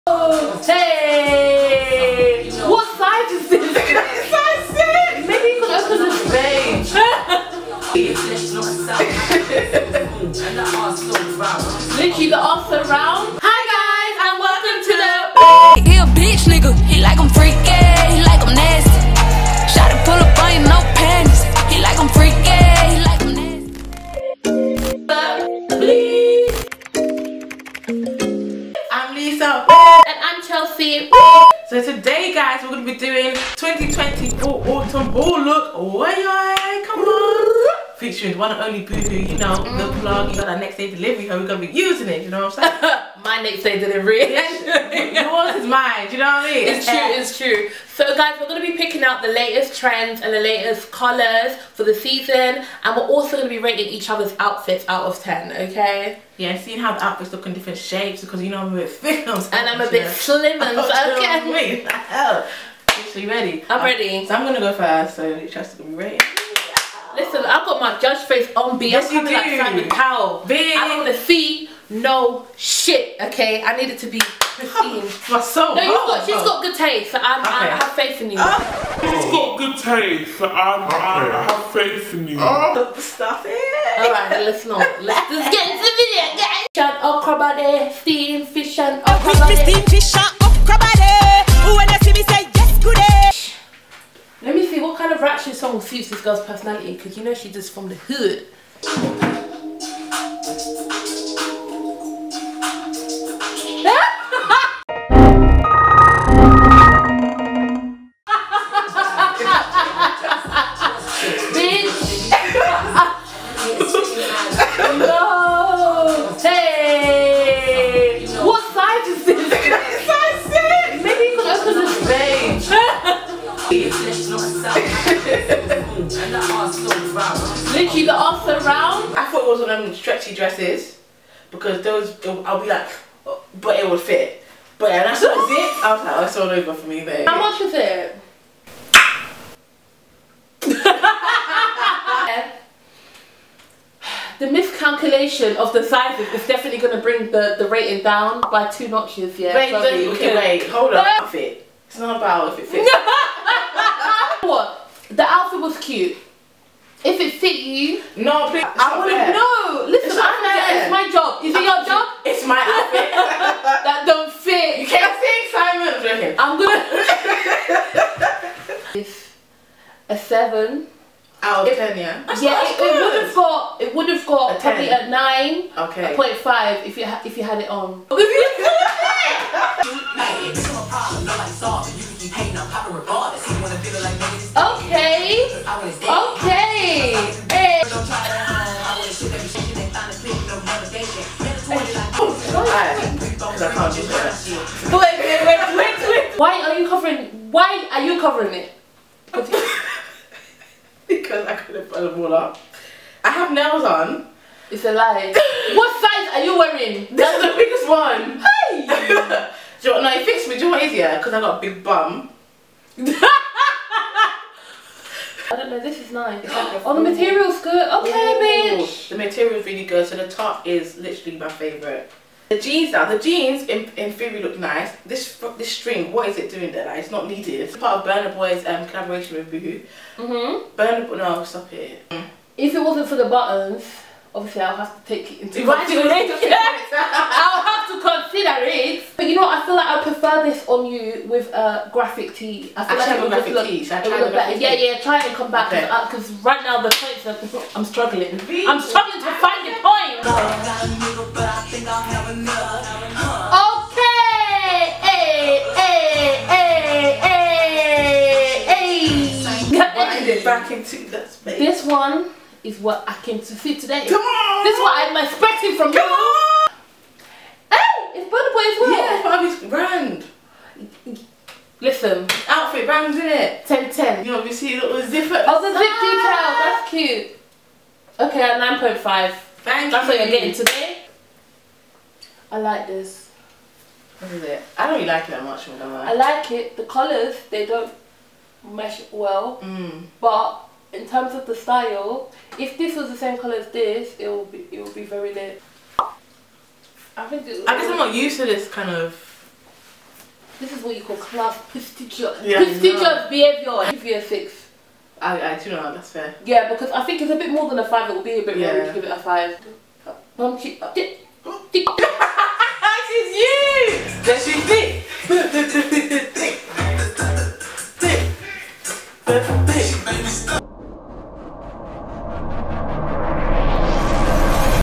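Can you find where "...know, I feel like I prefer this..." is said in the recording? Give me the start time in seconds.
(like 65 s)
239 s.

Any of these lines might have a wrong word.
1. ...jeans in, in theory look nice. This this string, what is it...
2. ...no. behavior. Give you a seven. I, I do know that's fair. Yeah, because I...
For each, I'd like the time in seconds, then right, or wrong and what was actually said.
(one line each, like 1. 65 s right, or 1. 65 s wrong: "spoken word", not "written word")
1. 223 s right
2. 303 s wrong: "six", not "seven".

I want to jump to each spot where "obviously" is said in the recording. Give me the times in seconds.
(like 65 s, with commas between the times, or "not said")
234 s, 274 s.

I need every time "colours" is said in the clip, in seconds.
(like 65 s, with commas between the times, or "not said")
50 s, 286 s, 293 s.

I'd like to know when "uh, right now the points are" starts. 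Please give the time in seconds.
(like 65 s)
246 s.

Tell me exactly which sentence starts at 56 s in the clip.
Yeah, seeing how the outfits look in different shapes because you know I'm a bit thick.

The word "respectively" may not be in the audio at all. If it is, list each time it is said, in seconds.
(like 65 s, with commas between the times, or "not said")
not said.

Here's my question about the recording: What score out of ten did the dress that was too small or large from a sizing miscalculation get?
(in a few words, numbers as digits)
7.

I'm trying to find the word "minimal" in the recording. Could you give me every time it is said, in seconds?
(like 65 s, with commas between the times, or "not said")
not said.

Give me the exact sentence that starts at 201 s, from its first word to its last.
because I couldn't put them all up.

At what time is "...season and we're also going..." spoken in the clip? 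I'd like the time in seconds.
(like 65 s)
51 s.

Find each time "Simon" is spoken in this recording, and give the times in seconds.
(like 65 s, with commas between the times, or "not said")
69 s, 165 s.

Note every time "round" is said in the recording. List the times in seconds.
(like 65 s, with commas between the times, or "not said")
12 s, 128 s.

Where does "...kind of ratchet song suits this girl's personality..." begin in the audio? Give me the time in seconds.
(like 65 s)
94 s.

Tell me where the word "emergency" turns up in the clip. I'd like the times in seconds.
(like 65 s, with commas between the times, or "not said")
not said.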